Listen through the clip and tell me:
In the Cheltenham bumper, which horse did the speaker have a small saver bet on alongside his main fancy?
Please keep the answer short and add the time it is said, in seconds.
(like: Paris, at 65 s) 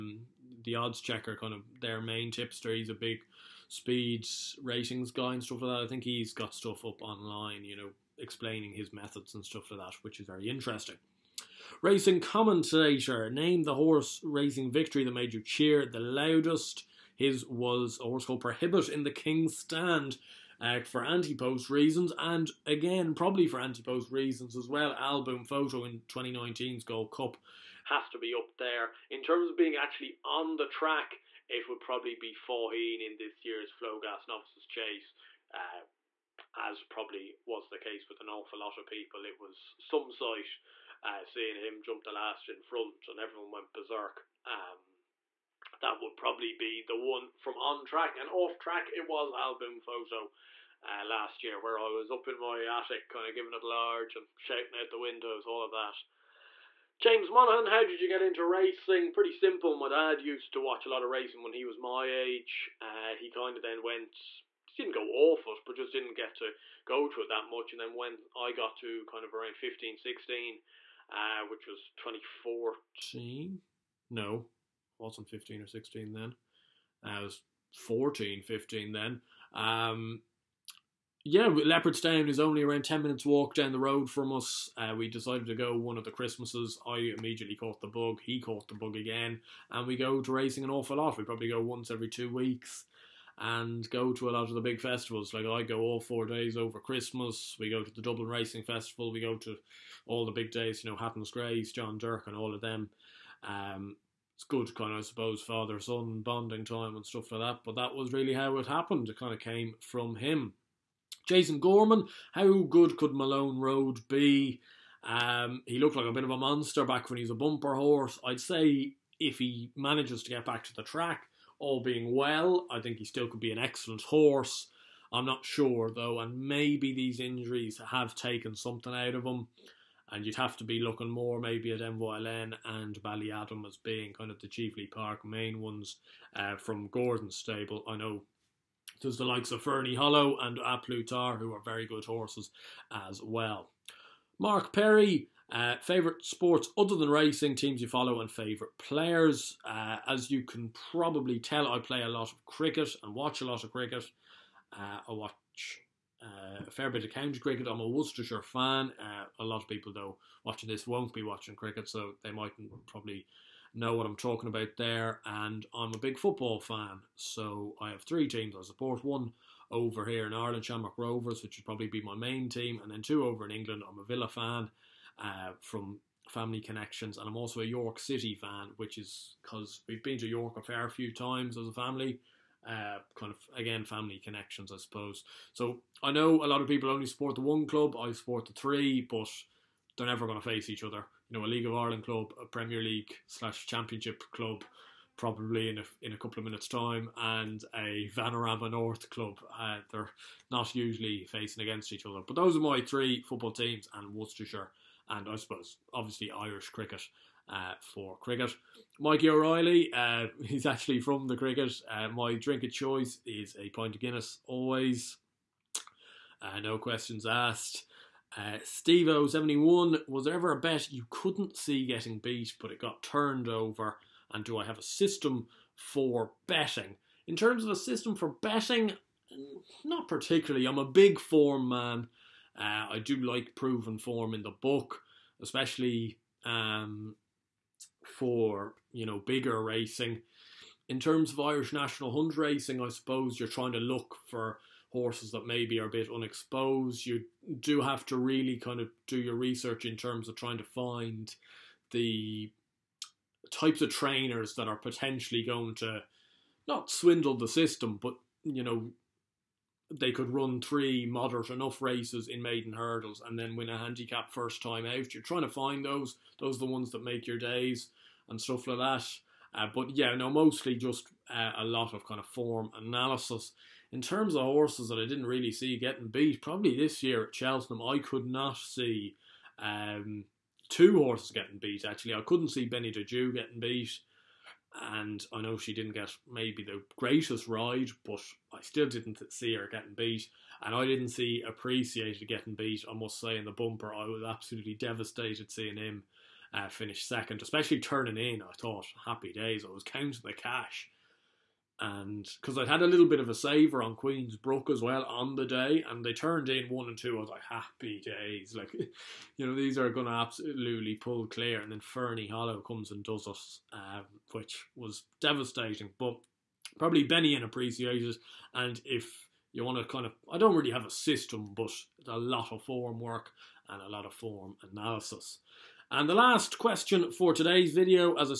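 Queens Brook, at 303 s.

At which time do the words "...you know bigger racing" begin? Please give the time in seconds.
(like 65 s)
238 s.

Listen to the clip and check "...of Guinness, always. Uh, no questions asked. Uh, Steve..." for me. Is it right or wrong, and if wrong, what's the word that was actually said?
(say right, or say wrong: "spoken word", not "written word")
right.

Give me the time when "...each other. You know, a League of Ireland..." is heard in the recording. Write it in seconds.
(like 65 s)
190 s.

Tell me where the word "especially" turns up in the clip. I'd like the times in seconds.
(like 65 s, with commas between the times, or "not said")
235 s, 297 s.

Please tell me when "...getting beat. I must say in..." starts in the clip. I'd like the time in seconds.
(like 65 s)
292 s.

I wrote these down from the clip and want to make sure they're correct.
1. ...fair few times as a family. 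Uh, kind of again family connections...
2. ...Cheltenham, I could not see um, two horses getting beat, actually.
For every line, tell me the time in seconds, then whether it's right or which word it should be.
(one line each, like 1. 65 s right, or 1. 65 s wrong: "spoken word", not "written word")
1. 180 s right
2. 277 s right.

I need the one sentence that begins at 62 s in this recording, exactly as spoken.
Uh, he kind of then went didn't go awful, but just didn't get to go to it that much.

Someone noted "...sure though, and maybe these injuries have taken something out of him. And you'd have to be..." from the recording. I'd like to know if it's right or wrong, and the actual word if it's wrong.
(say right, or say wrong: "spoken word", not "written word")
right.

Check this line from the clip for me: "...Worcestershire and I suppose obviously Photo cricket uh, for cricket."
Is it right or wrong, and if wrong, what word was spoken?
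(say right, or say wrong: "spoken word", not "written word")
wrong: "Irish", not "Photo".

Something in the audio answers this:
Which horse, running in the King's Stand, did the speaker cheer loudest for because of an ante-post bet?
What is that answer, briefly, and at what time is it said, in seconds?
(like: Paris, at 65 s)
Prohibit, at 18 s.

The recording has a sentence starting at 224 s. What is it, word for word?
And do I have a system for betting?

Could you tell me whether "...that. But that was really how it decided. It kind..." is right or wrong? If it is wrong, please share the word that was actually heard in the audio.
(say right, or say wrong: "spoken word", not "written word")
wrong: "happened", not "decided".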